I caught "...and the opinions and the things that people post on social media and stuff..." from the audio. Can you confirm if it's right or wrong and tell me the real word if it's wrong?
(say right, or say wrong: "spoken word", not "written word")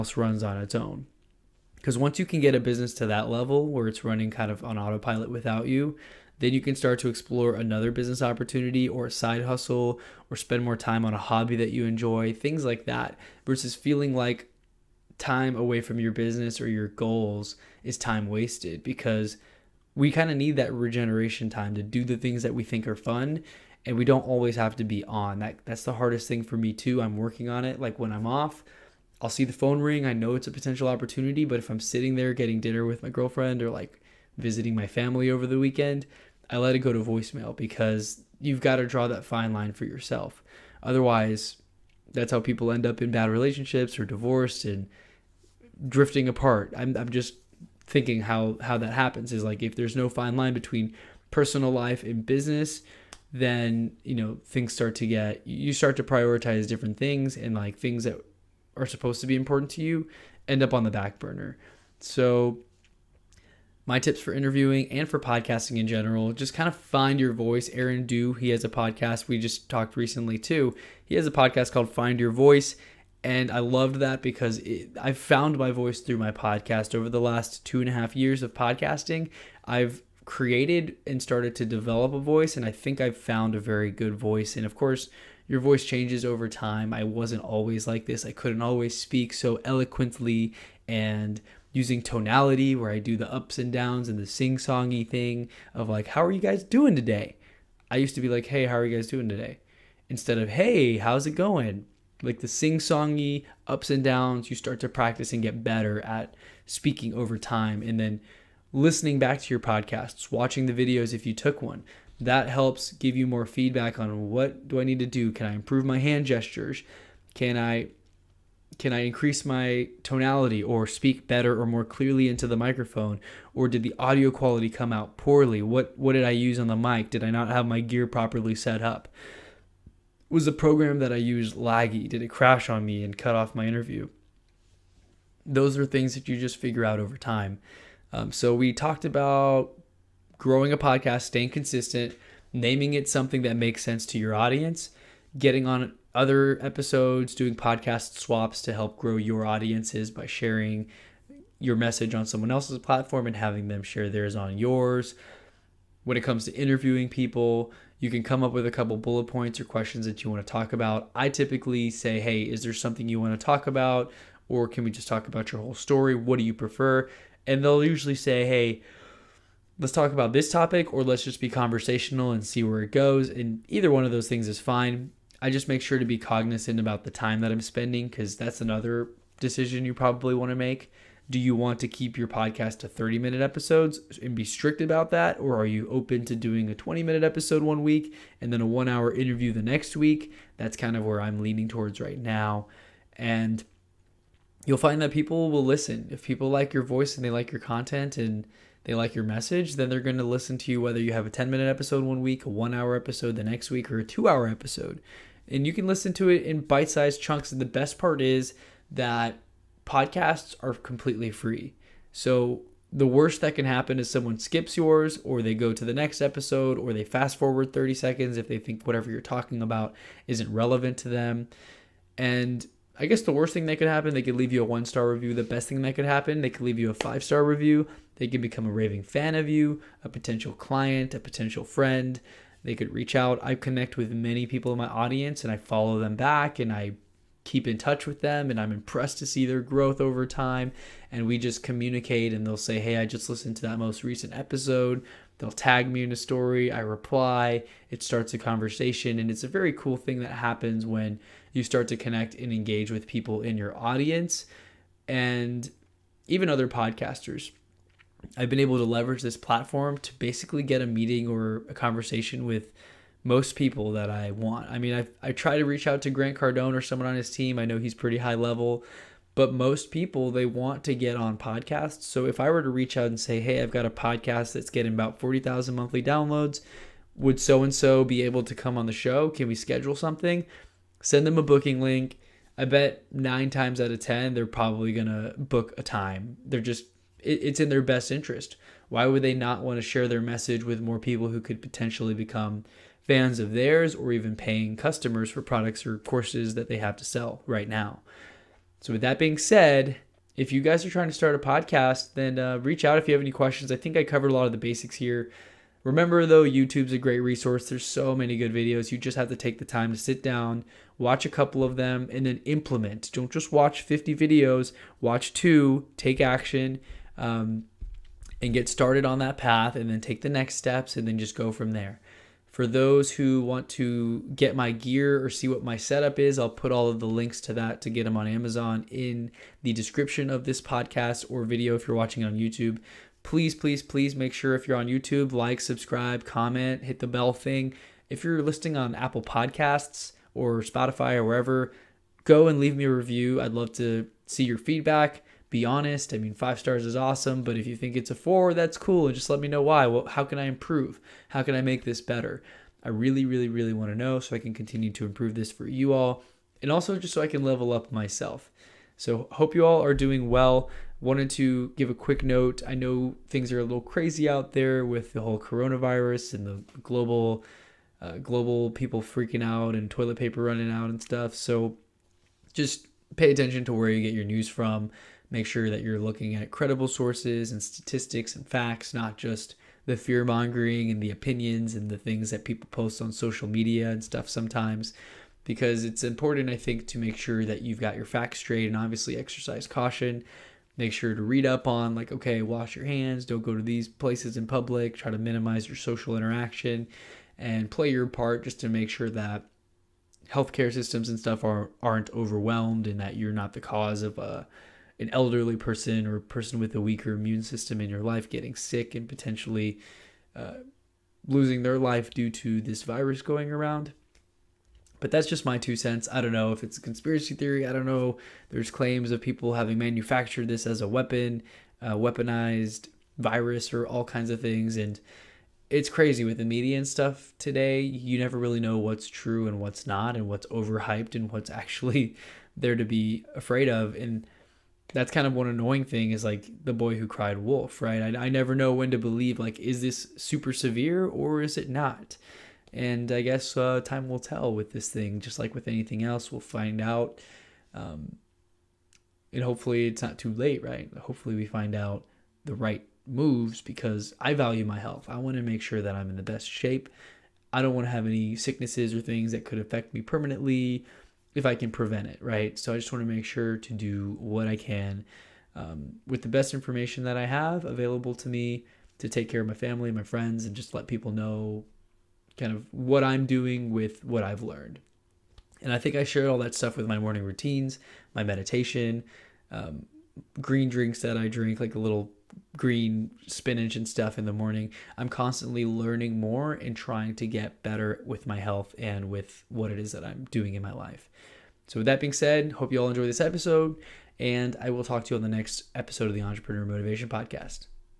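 right.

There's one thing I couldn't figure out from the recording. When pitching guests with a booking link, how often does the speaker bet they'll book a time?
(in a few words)
9 times out of 10.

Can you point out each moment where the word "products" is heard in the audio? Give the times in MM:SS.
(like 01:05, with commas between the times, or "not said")
04:55.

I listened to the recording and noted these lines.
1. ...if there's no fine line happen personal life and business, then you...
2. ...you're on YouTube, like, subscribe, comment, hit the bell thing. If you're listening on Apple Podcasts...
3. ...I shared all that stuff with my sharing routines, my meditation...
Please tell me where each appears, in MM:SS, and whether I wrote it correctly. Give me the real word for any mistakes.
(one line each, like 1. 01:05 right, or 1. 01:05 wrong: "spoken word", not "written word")
1. 00:49 wrong: "between", not "happen"
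2. 05:34 right
3. 07:55 wrong: "morning", not "sharing".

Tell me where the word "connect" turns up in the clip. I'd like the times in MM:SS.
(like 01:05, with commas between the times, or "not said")
03:53, 04:11.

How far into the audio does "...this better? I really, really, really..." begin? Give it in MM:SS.
05:51.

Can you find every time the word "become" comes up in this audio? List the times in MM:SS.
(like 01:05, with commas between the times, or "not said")
03:48, 04:52.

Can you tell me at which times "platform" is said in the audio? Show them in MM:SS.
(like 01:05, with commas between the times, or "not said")
02:32, 04:19.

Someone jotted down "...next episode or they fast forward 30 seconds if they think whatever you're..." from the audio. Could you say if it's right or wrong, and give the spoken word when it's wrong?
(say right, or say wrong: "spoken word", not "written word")
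right.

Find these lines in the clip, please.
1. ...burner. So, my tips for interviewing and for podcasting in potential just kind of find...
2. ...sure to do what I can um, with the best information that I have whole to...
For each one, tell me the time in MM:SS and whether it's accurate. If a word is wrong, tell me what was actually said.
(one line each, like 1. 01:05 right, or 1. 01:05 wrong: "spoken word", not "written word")
1. 01:01 wrong: "general", not "potential"
2. 07:43 wrong: "available", not "whole".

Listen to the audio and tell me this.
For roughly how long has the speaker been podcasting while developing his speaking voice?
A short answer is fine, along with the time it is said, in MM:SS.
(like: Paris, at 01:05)
2.5 years, at 01:17.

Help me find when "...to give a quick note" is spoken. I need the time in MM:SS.
06:01.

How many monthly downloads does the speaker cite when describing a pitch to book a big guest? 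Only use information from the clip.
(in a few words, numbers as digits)
40,000.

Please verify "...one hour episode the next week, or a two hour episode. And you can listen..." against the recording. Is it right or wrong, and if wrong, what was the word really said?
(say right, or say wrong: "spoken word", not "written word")
right.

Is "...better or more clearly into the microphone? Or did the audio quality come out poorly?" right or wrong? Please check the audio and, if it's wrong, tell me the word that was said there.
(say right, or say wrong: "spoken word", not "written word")
right.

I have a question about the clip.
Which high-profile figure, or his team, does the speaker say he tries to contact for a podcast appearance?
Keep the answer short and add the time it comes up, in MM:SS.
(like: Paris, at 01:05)
Grant Cardone, at 04:26.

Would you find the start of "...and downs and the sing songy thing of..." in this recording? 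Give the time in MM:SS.
01:33.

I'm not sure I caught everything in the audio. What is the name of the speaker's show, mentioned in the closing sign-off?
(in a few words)
Entrepreneur Motivation Podcast.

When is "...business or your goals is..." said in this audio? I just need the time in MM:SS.
00:16.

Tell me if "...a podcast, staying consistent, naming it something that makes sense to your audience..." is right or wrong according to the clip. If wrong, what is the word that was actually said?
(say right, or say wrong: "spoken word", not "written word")
right.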